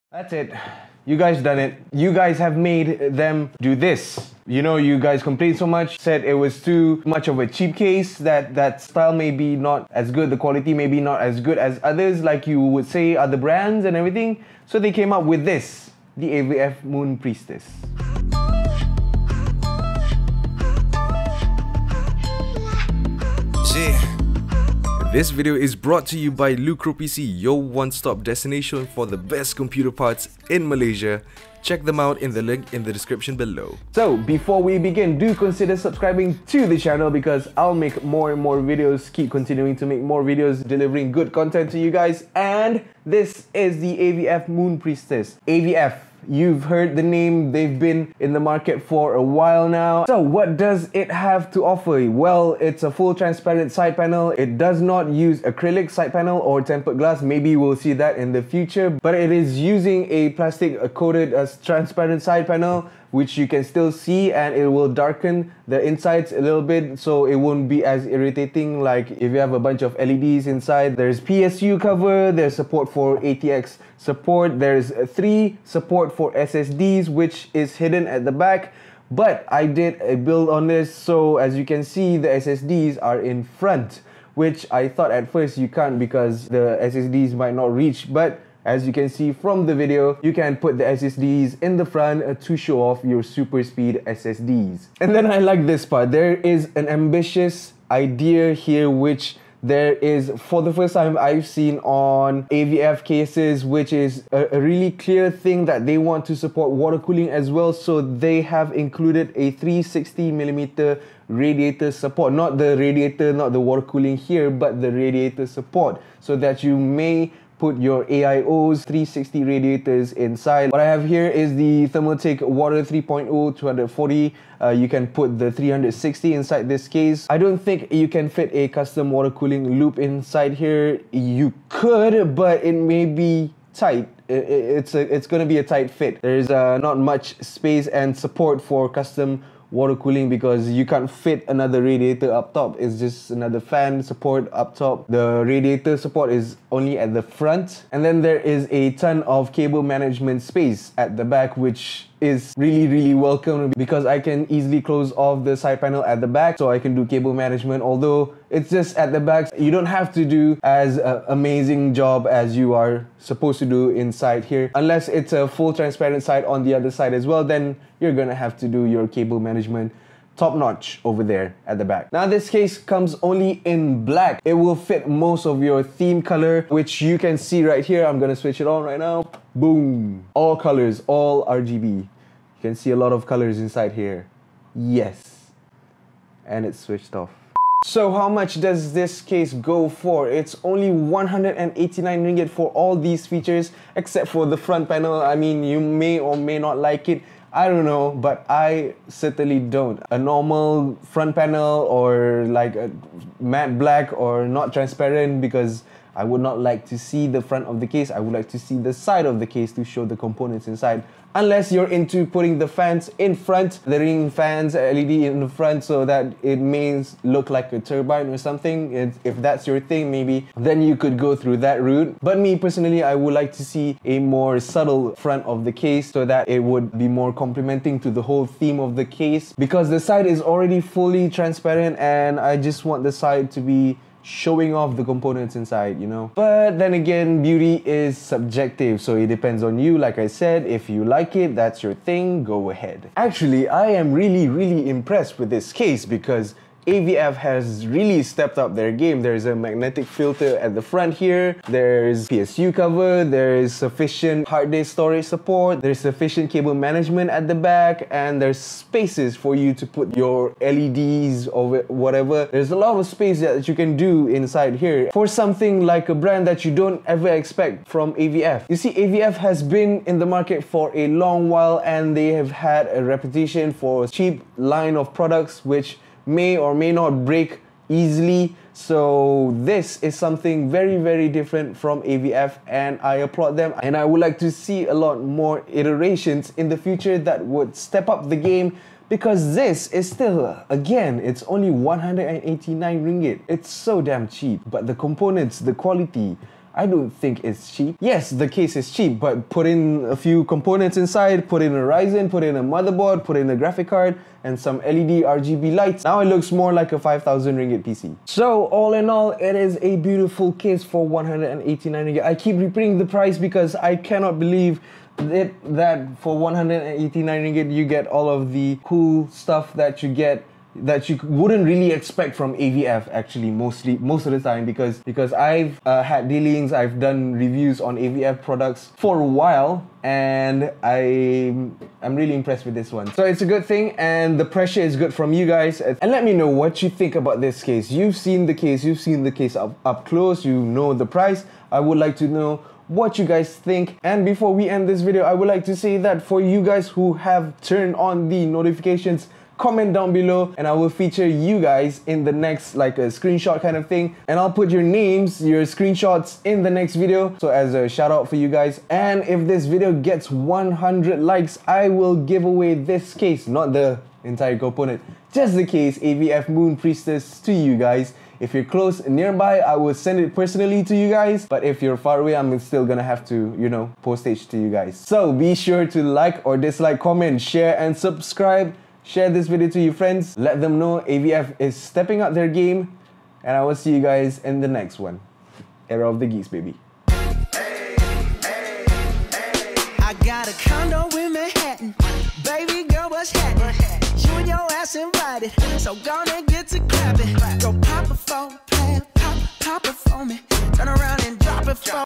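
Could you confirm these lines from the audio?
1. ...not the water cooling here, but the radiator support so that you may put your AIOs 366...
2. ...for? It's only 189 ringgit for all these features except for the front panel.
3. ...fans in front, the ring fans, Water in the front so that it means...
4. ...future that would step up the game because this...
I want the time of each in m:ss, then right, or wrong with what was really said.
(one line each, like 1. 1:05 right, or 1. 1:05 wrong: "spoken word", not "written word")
1. 1:53 wrong: "360", not "366"
2. 3:09 right
3. 3:32 wrong: "LED", not "Water"
4. 4:46 right.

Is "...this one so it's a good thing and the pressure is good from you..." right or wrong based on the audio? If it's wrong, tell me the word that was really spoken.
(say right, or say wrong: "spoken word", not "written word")
right.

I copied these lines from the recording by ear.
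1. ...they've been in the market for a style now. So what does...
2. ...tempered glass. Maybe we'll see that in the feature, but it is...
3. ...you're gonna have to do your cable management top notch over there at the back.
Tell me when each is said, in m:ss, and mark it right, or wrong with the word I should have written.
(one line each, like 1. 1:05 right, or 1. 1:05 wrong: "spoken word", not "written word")
1. 0:47 wrong: "while", not "style"
2. 0:56 wrong: "future", not "feature"
3. 2:47 right.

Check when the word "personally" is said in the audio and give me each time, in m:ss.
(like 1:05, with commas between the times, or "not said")
3:42, 6:10.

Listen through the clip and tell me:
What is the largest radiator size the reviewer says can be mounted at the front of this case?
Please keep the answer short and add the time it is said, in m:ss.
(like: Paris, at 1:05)
360 millimeter, at 1:49.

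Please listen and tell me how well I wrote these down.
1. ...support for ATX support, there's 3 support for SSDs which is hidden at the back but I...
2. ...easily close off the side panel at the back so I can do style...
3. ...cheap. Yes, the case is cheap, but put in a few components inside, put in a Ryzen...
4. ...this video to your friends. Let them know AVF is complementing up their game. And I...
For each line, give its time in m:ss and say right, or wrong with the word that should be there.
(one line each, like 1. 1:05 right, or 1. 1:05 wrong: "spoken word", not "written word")
1. 1:12 right
2. 2:34 wrong: "cable", not "style"
3. 4:57 right
4. 6:19 wrong: "stepping", not "complementing".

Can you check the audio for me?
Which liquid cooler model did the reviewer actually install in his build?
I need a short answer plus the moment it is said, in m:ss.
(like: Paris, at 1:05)
Thermaltake Water 3.0 240, at 2:01.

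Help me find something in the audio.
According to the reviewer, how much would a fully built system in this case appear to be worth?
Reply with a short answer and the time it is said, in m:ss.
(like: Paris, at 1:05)
5,000 ringgit, at 5:06.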